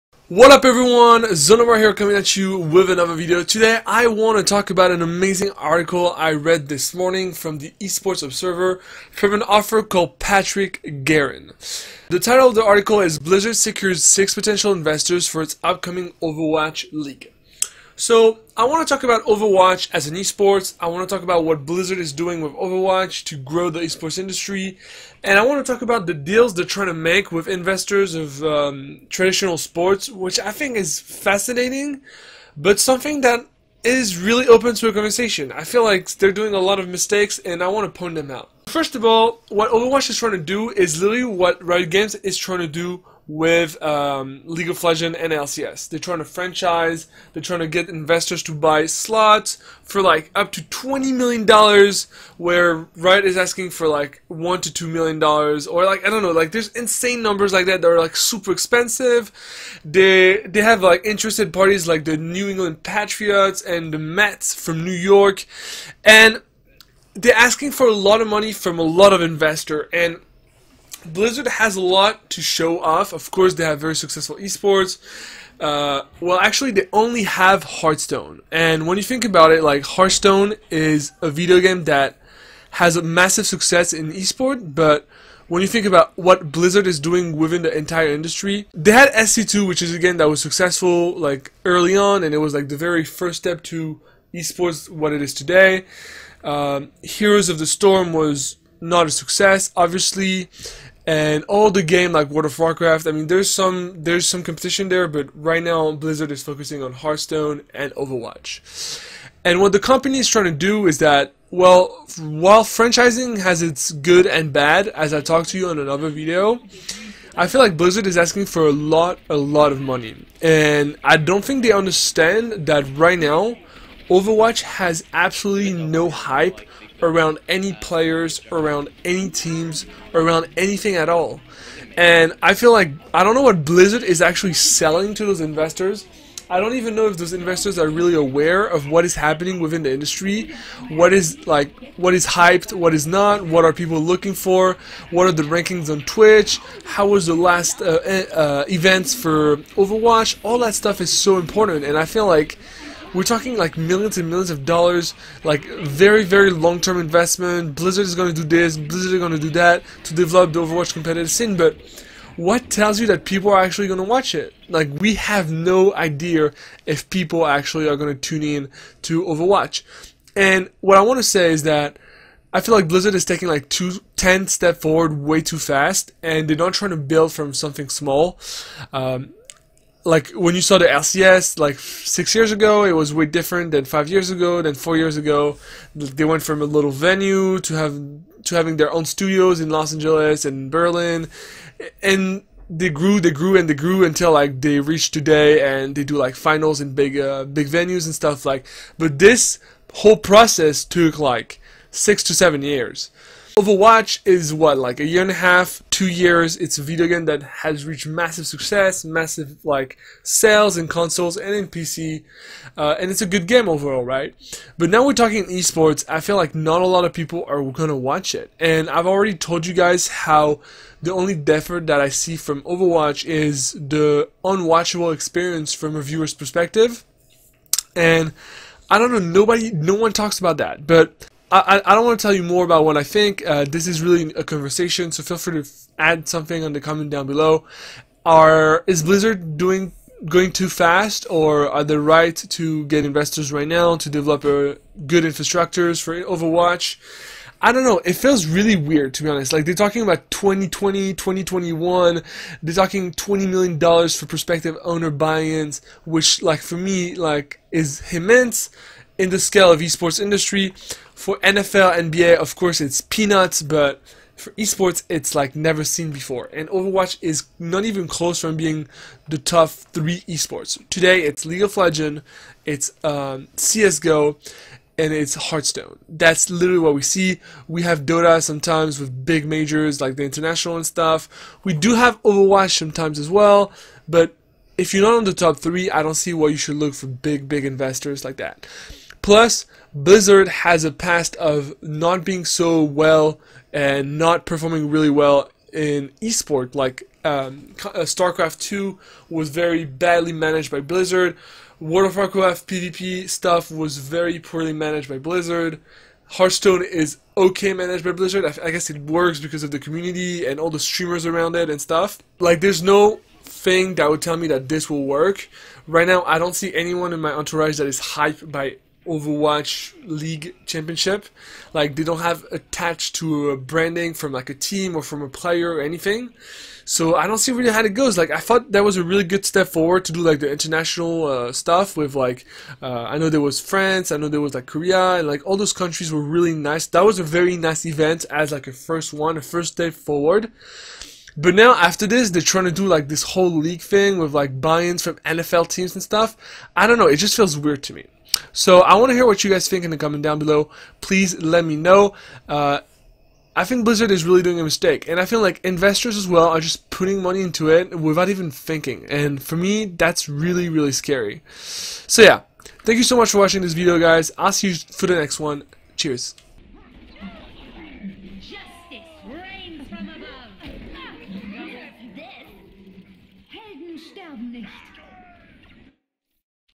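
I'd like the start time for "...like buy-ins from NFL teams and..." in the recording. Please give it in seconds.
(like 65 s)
344 s.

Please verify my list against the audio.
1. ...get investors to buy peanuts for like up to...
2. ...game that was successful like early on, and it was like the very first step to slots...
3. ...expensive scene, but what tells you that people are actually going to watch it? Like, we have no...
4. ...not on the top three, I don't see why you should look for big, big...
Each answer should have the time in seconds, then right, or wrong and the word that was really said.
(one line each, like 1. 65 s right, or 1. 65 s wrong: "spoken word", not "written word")
1. 47 s wrong: "slots", not "peanuts"
2. 89 s wrong: "esports", not "slots"
3. 160 s wrong: "competitive", not "expensive"
4. 285 s right.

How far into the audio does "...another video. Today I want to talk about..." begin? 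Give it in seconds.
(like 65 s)
2 s.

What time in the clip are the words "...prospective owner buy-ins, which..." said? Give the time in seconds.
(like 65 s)
254 s.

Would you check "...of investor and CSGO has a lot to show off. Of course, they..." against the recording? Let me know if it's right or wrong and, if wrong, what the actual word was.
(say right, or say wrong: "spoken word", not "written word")
wrong: "Blizzard", not "CSGO".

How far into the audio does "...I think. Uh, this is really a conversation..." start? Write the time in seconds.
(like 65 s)
232 s.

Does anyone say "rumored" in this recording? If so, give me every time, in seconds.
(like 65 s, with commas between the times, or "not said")
not said.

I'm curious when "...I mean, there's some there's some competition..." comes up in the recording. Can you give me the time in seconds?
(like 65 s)
103 s.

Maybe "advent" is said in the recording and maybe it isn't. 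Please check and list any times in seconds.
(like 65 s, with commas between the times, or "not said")
not said.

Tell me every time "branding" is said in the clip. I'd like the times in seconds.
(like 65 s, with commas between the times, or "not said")
323 s.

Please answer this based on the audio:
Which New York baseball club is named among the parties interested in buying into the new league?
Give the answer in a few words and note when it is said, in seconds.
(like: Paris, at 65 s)
the Mets, at 63 s.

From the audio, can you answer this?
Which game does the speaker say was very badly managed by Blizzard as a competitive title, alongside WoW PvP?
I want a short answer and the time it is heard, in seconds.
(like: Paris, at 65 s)
StarCraft 2, at 297 s.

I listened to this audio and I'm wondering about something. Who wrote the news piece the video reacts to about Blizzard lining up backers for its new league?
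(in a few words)
Patrick Garren.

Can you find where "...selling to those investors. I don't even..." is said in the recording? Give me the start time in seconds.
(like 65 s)
134 s.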